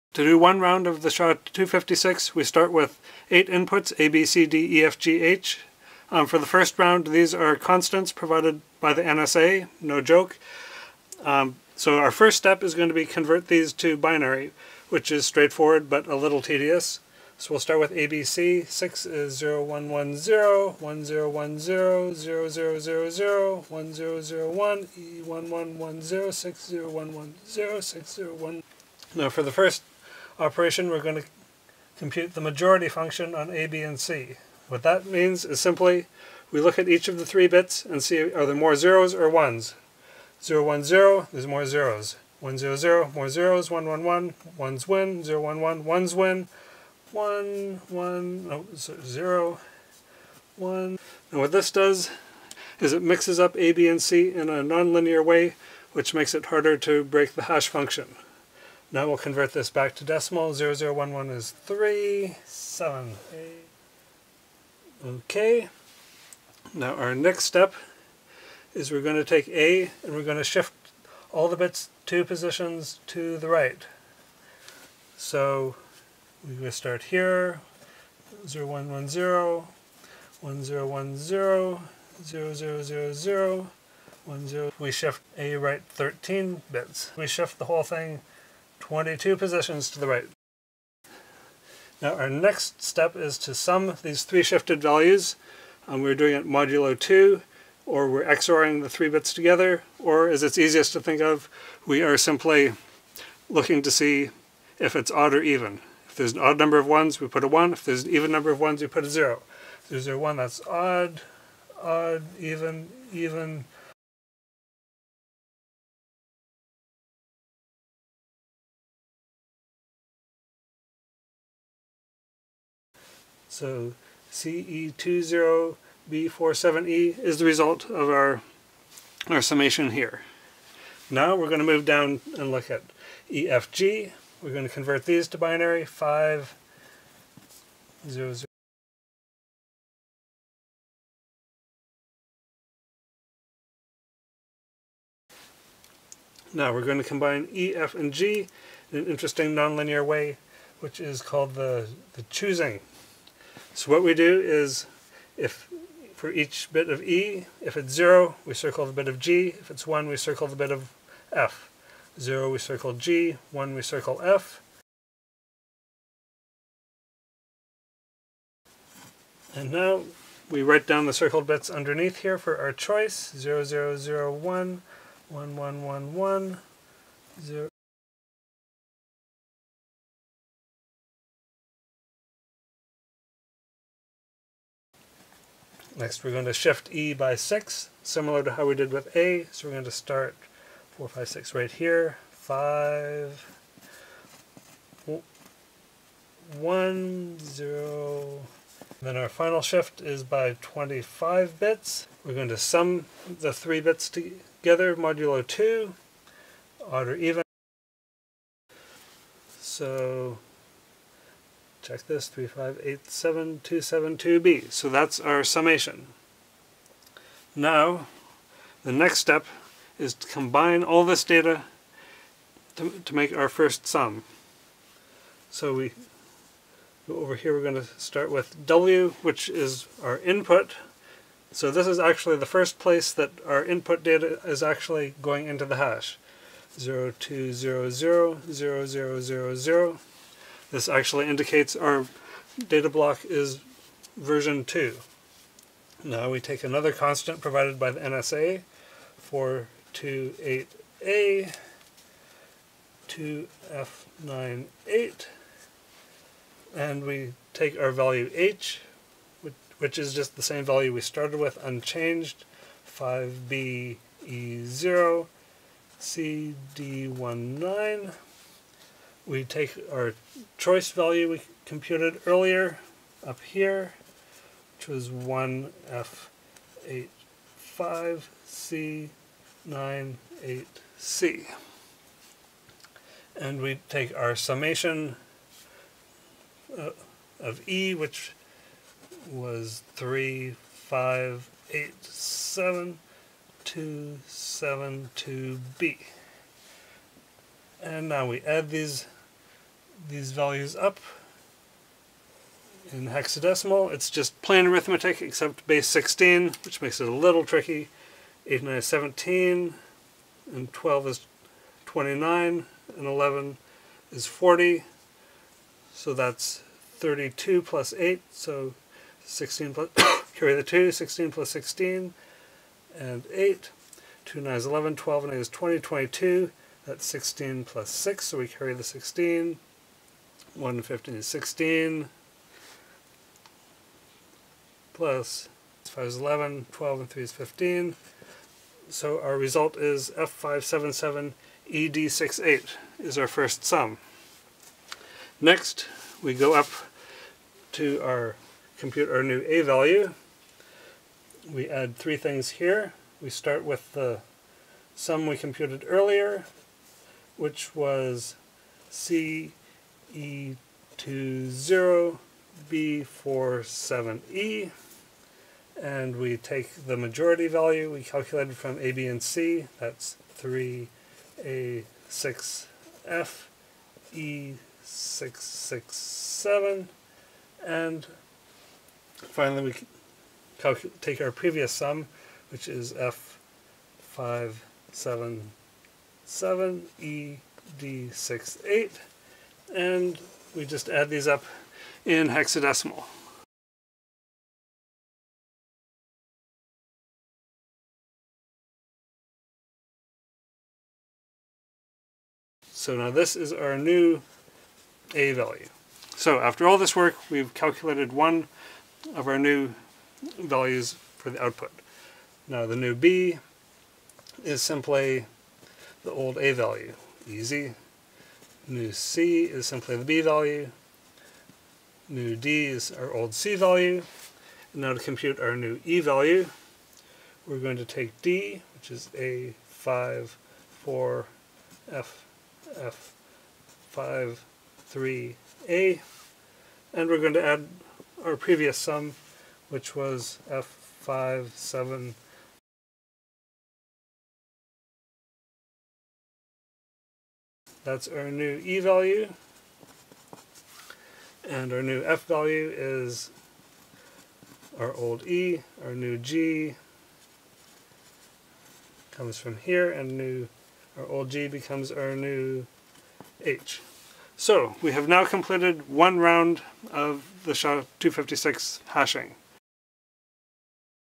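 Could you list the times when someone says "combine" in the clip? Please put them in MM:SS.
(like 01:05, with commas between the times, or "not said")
02:27, 03:40.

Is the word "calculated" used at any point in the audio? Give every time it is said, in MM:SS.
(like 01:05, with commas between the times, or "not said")
06:08, 06:47.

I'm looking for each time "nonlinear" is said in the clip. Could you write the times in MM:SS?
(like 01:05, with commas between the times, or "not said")
00:54, 02:29.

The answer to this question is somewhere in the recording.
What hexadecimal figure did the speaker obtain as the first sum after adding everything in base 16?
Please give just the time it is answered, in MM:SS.
05:40.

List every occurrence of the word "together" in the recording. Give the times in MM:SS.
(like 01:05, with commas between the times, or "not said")
01:39, 03:24.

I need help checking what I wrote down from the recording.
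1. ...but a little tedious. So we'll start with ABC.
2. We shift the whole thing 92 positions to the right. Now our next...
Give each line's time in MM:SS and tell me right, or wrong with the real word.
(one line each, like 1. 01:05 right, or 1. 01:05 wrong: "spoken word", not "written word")
1. 00:15 right
2. 01:27 wrong: "22", not "92".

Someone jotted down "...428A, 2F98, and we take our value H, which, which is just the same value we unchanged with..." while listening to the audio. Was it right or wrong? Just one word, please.
wrong.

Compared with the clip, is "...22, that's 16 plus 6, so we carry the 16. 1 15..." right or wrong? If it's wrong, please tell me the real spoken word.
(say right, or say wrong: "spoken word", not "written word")
right.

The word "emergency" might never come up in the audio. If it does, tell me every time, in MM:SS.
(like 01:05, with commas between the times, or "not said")
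not said.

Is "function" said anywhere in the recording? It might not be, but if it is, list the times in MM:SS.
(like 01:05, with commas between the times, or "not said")
00:32, 00:57.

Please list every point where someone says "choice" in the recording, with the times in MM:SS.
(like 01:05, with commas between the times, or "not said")
02:52, 04:30.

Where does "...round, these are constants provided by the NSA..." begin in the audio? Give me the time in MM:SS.
00:06.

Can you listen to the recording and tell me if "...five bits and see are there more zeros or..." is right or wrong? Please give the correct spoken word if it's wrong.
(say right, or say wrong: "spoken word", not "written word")
wrong: "three", not "five".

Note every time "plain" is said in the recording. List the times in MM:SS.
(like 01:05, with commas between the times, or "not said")
05:04.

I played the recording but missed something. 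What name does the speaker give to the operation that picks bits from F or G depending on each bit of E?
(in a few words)
choosing.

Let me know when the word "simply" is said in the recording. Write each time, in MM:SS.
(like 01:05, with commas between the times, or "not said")
00:35, 01:42, 06:54, 06:59.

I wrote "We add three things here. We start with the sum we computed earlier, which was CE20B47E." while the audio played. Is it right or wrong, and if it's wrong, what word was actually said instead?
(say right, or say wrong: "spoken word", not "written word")
right.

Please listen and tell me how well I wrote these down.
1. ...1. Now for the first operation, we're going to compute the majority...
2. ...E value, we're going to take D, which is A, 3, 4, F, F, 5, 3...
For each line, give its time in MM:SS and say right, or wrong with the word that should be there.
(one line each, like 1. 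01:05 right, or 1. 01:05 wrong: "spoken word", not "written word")
1. 00:28 right
2. 07:05 wrong: "5", not "3".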